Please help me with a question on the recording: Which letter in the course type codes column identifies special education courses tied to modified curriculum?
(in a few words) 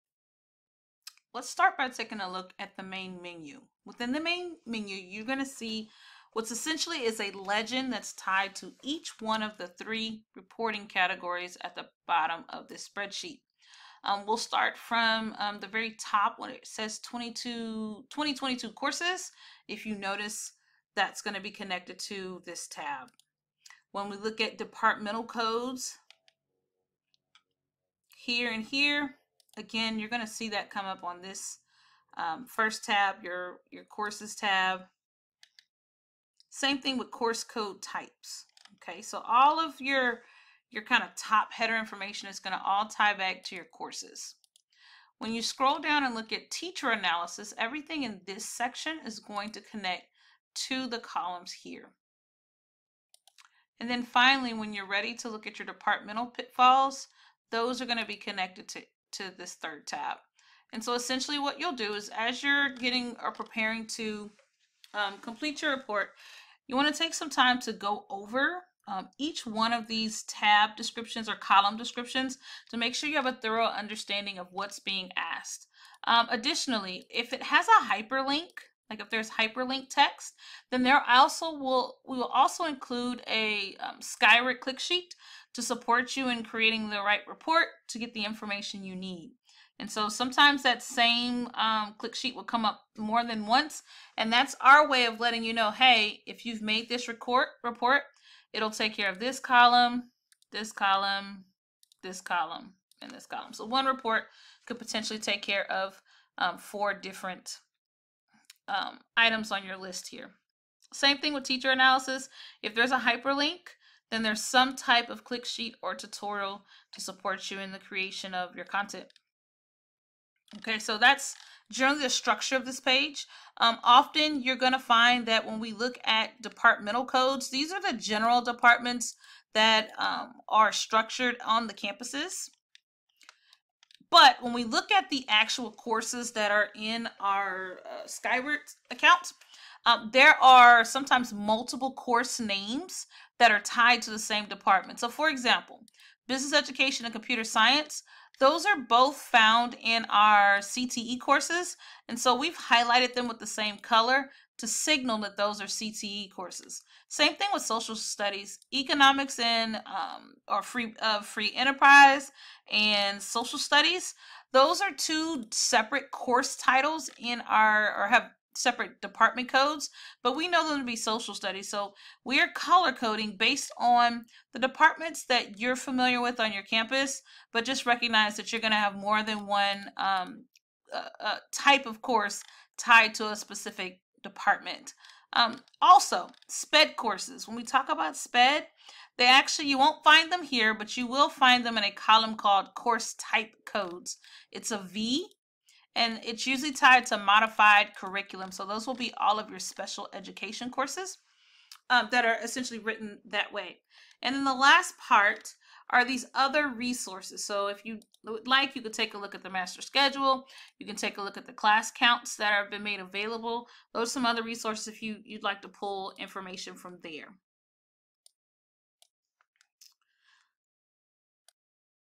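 V.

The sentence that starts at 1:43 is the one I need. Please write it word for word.
So one report could potentially take care of um, four different um, items on your list here.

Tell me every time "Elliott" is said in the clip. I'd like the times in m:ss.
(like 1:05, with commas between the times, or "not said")
not said.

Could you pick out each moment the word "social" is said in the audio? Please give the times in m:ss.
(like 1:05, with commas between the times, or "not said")
2:37, 2:43, 2:50.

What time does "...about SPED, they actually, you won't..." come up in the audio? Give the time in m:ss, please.
3:07.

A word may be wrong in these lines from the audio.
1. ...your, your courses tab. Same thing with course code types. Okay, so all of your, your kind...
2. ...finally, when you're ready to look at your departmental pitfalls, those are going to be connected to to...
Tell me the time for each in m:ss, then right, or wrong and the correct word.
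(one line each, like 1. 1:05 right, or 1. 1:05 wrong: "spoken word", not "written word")
1. 0:33 right
2. 0:54 right.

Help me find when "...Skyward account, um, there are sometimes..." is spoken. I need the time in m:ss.
2:18.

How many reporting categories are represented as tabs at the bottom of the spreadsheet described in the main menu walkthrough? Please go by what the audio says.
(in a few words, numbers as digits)
3.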